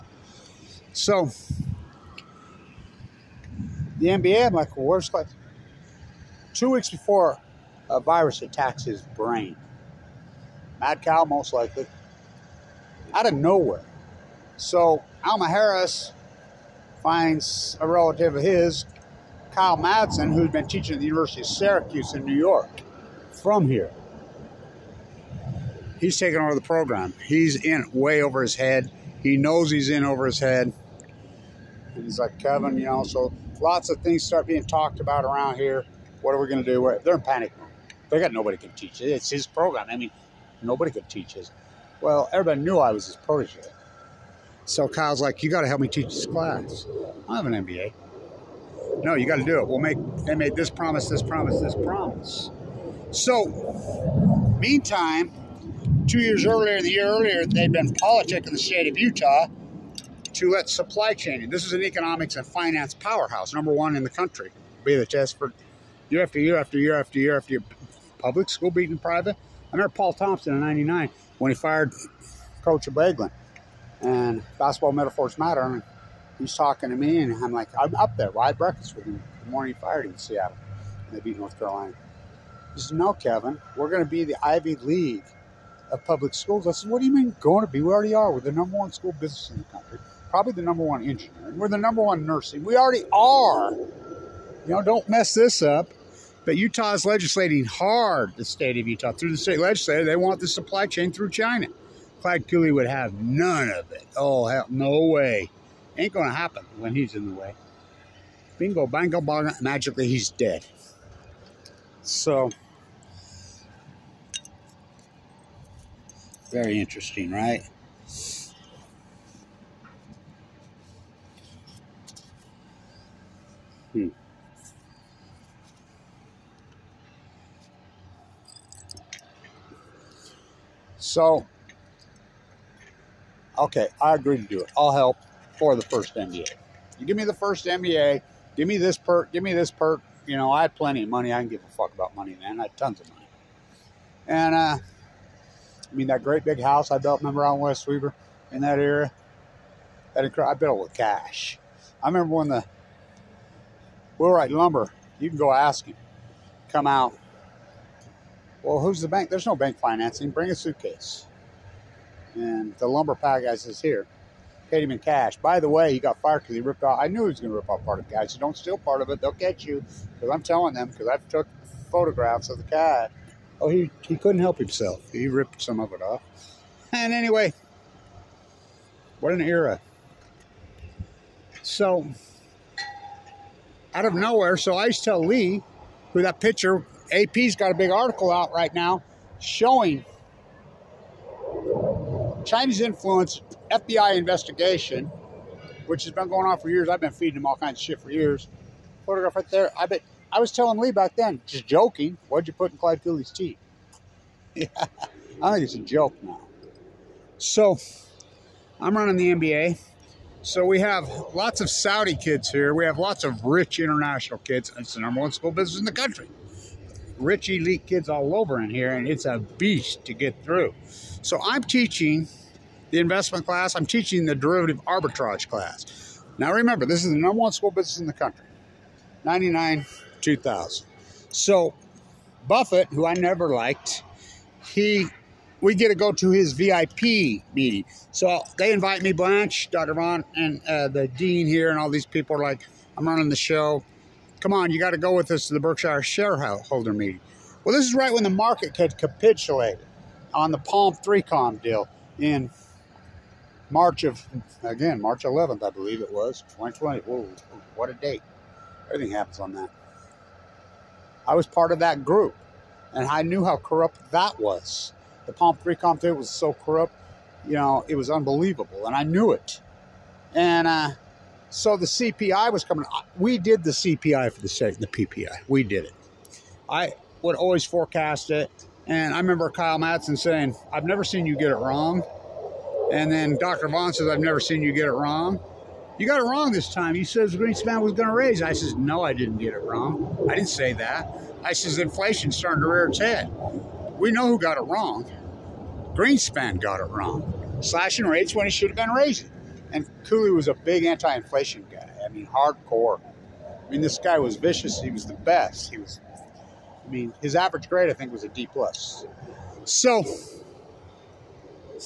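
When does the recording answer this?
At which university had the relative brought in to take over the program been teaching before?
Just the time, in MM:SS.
00:21.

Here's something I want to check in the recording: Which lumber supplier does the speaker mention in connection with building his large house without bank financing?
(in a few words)
Wheelwright Lumber.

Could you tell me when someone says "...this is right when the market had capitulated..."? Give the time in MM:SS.
04:07.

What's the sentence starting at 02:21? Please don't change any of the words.
I didn't give a fuck about money man.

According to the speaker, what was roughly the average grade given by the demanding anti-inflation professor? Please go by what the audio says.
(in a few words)
D plus.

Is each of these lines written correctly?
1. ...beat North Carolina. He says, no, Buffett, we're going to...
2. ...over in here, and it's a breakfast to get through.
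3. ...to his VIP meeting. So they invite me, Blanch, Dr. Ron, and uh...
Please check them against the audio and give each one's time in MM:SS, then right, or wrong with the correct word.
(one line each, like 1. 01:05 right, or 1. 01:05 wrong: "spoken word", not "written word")
1. 01:21 wrong: "Kevin", not "Buffett"
2. 03:38 wrong: "beast", not "breakfast"
3. 03:56 right.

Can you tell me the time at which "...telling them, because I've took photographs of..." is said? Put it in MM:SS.
02:50.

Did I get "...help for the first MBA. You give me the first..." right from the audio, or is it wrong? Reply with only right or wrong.
right.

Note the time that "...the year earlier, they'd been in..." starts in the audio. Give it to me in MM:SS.
00:56.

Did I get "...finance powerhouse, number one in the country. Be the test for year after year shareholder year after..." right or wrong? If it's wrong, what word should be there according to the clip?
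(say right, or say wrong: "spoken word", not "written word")
wrong: "after", not "shareholder".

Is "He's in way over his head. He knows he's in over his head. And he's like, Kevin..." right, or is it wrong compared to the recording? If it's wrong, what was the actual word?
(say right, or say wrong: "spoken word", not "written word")
right.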